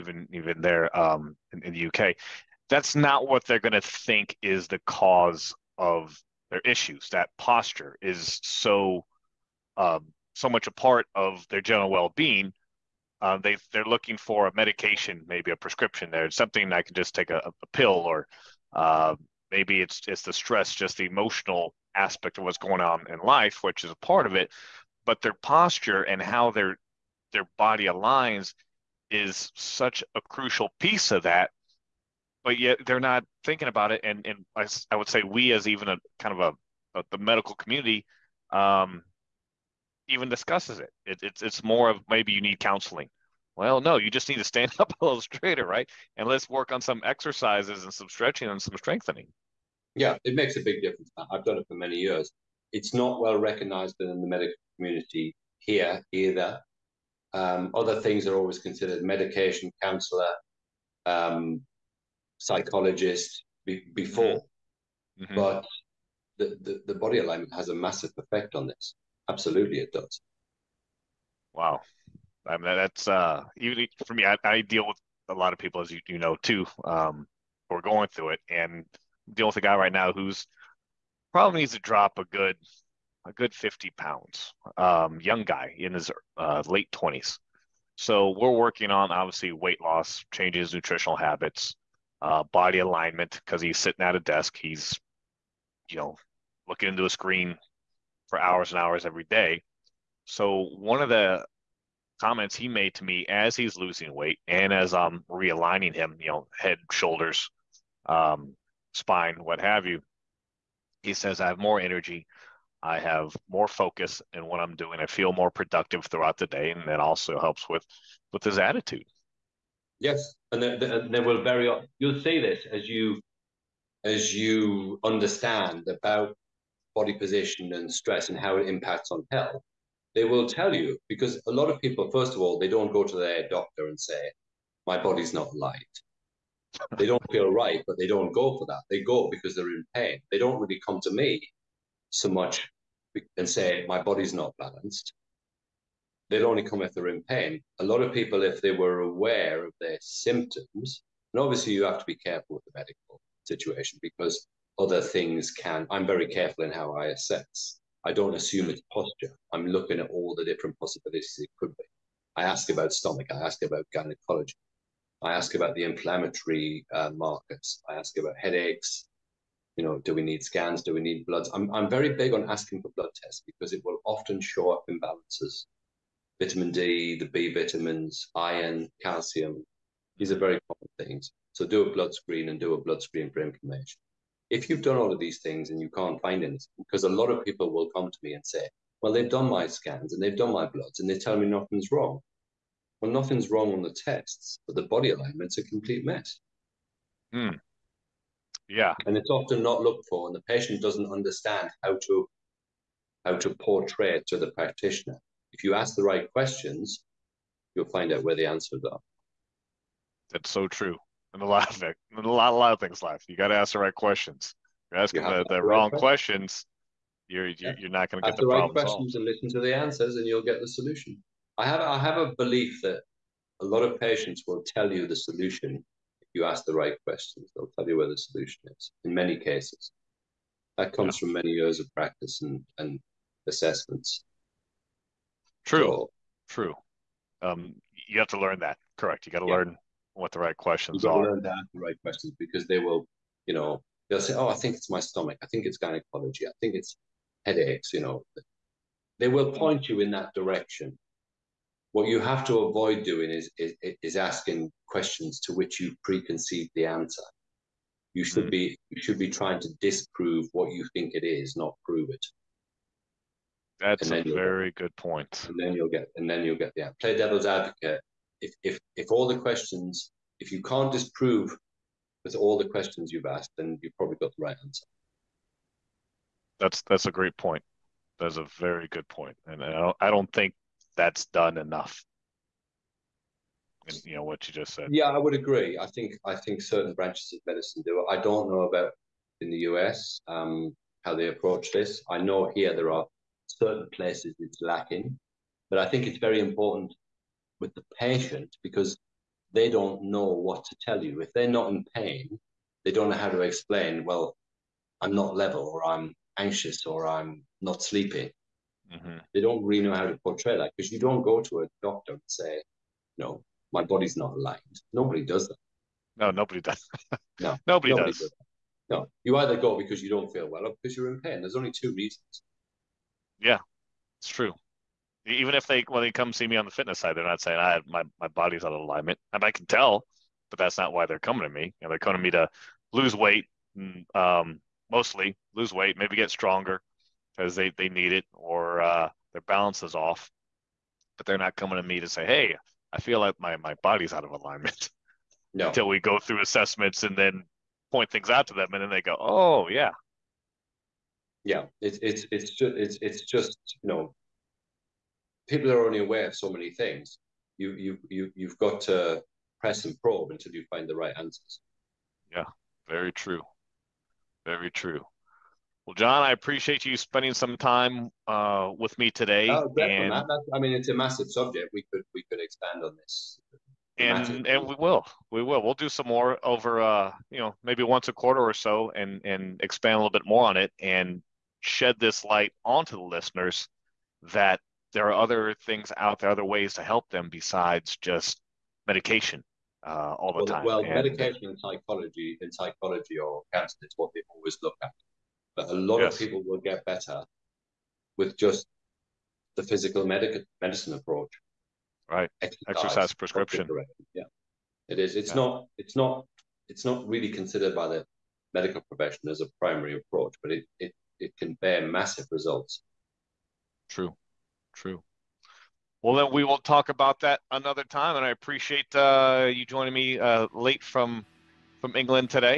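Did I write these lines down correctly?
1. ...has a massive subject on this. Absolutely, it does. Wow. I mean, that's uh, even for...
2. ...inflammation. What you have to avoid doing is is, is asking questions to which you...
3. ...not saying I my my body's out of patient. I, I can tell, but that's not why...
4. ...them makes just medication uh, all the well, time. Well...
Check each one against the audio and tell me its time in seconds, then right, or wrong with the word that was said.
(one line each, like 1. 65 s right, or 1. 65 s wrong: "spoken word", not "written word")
1. 67 s wrong: "effect", not "subject"
2. 250 s wrong: "direction", not "inflammation"
3. 327 s wrong: "alignment", not "patient"
4. 387 s wrong: "besides", not "makes".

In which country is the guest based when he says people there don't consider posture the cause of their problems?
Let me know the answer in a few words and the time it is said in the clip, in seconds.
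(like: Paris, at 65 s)
UK, at 1 s.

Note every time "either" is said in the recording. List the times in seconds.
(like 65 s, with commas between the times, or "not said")
56 s, 319 s.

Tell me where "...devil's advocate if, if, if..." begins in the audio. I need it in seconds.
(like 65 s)
267 s.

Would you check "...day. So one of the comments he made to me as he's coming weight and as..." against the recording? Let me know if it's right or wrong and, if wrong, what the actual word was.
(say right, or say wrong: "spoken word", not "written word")
wrong: "losing", not "coming".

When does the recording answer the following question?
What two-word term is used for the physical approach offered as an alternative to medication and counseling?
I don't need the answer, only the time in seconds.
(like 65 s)
402 s.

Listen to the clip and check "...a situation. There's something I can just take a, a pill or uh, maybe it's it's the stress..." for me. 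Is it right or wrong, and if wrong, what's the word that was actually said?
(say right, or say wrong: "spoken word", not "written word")
wrong: "prescription", not "situation".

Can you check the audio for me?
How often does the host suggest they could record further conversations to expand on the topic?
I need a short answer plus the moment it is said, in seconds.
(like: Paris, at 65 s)
once a quarter, at 377 s.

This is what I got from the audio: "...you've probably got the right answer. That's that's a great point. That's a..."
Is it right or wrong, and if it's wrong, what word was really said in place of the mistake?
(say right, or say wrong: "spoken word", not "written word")
right.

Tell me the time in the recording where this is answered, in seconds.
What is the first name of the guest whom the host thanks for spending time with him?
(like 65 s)
365 s.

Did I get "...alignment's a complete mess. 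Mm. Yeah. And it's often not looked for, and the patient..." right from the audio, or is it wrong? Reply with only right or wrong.
right.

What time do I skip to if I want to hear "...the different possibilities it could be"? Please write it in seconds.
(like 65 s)
160 s.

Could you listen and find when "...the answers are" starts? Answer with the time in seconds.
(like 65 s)
208 s.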